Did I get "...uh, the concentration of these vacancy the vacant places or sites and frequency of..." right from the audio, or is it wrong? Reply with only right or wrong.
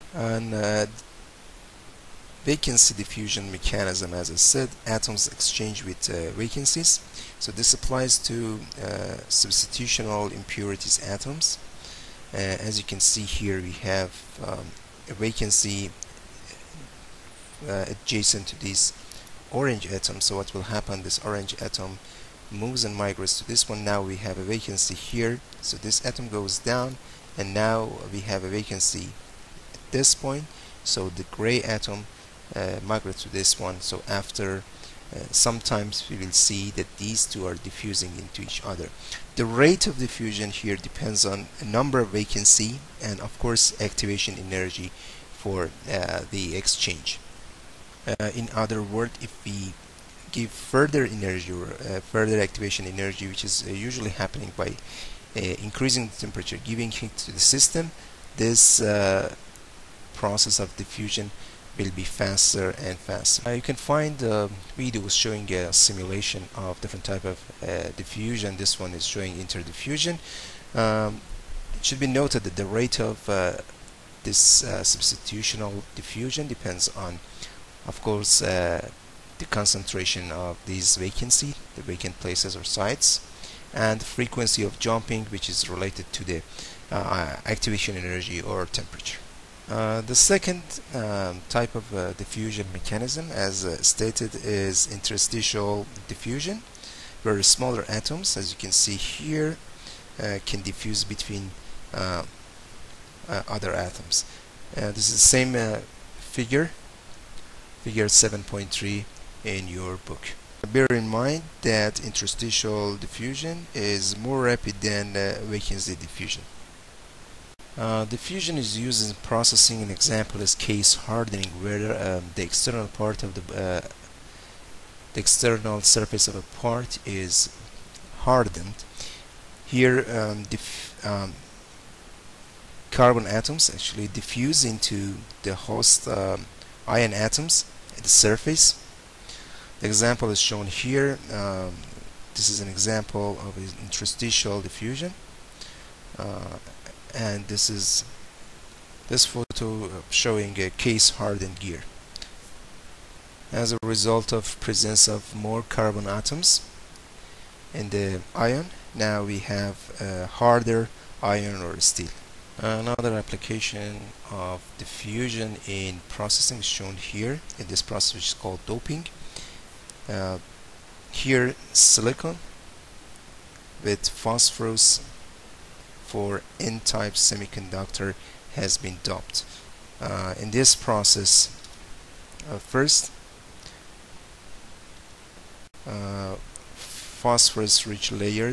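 right.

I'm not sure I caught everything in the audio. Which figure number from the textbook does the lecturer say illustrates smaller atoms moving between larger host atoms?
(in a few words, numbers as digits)
Figure 7.3.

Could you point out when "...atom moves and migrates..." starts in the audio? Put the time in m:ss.
0:21.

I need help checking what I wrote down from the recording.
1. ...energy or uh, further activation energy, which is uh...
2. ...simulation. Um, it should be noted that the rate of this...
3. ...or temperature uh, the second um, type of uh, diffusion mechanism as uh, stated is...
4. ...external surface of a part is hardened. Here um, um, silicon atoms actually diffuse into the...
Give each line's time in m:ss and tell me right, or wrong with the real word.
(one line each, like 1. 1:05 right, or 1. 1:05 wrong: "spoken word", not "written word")
1. 0:51 right
2. 1:09 wrong: "interdiffusion", not "simulation"
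3. 1:28 right
4. 2:05 wrong: "carbon", not "silicon".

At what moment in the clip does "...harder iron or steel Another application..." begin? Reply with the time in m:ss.
2:40.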